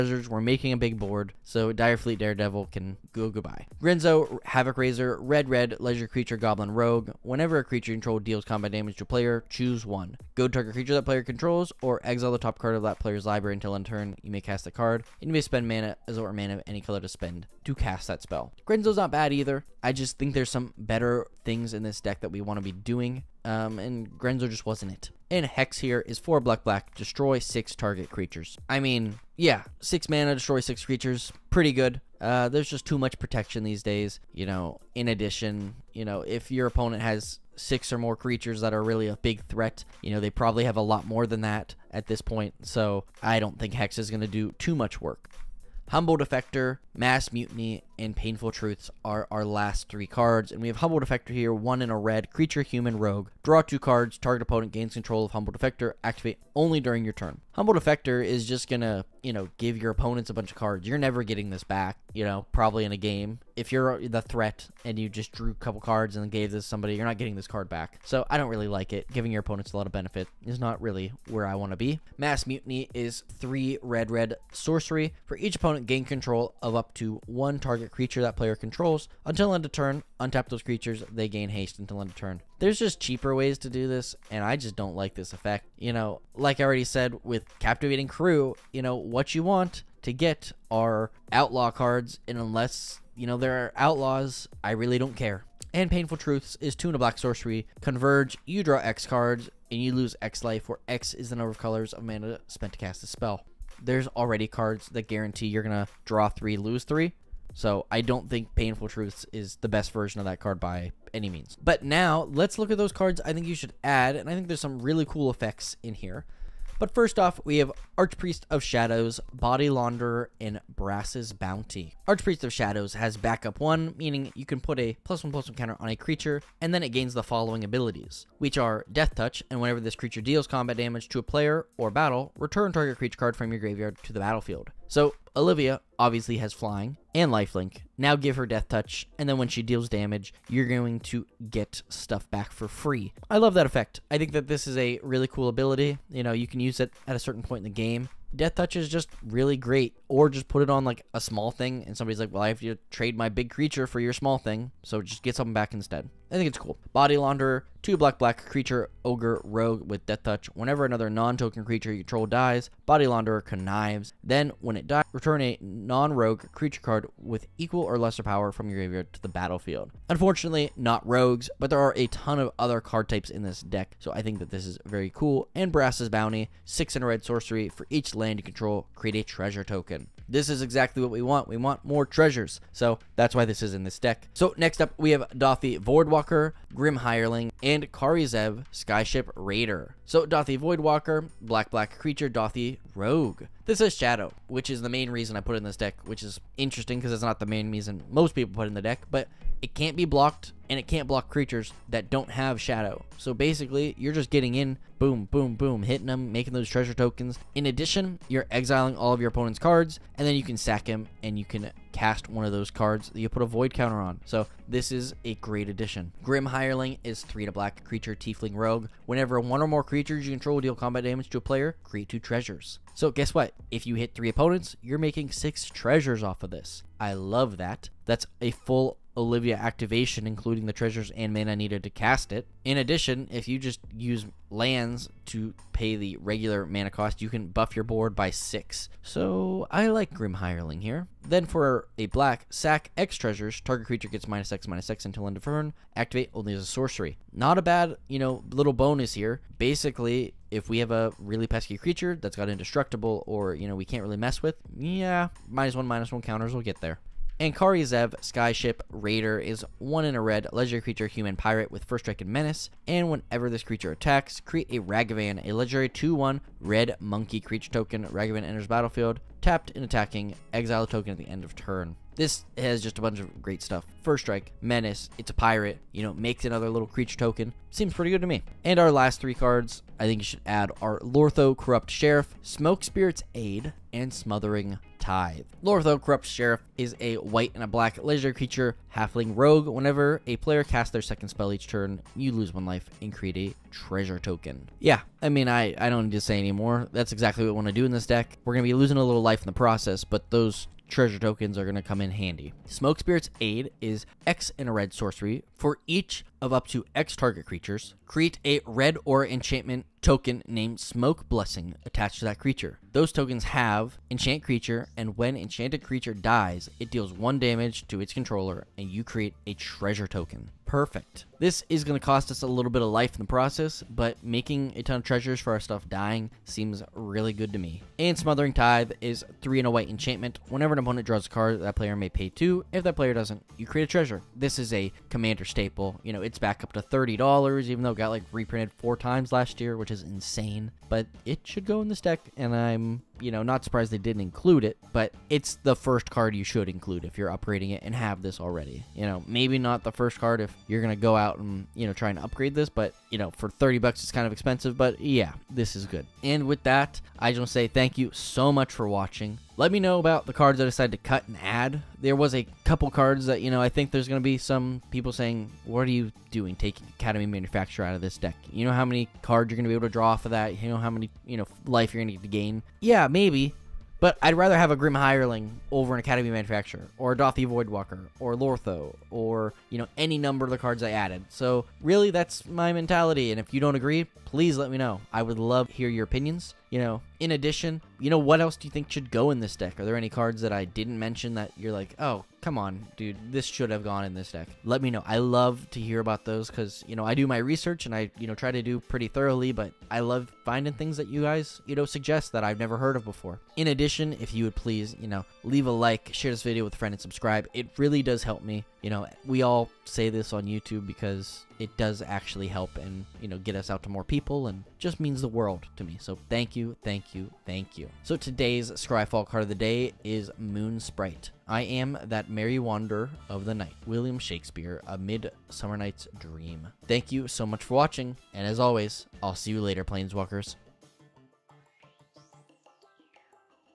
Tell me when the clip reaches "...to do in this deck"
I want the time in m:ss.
4:57.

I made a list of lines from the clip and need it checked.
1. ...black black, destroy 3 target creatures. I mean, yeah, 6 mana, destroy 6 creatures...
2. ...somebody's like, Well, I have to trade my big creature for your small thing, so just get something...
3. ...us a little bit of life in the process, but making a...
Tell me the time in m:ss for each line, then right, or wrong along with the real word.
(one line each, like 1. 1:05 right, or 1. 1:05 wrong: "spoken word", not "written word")
1. 0:26 wrong: "6", not "3"
2. 2:31 right
3. 5:22 right.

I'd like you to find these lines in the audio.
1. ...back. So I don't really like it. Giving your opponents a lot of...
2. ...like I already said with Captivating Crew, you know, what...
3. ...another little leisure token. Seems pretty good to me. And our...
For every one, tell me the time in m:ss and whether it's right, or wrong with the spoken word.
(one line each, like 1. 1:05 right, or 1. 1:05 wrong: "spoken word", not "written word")
1. 1:07 right
2. 1:26 right
3. 4:36 wrong: "creature", not "leisure".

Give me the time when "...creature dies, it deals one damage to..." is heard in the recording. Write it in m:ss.
5:15.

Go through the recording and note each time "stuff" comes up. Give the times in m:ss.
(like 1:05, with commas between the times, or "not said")
2:21, 4:33, 5:25.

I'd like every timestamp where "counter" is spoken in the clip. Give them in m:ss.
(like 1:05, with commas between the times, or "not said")
2:05, 3:33, 4:16.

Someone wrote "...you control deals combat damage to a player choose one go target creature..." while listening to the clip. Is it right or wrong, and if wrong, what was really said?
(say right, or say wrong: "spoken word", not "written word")
right.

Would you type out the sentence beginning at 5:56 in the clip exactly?
And with that, I just want to say thank you so much for watching.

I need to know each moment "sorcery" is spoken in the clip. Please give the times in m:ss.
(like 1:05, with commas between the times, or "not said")
1:14, 1:37, 2:57, 4:06, 5:04.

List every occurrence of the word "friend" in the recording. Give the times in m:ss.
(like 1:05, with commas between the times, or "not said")
6:46.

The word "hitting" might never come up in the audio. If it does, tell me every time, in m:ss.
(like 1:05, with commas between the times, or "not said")
3:25.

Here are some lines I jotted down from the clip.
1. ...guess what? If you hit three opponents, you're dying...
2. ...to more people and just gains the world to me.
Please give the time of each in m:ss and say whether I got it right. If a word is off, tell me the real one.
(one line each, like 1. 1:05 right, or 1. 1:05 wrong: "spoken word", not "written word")
1. 3:43 wrong: "making", not "dying"
2. 6:53 wrong: "means", not "gains".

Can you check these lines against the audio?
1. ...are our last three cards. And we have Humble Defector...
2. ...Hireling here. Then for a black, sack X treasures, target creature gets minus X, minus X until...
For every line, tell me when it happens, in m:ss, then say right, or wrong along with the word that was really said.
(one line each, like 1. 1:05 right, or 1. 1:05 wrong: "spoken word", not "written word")
1. 0:49 right
2. 4:00 right.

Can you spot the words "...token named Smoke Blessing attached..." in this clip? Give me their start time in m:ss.
5:10.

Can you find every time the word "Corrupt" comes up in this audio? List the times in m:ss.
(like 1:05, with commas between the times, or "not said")
4:41, 4:46.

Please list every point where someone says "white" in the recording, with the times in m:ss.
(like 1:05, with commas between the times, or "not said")
4:47, 5:29.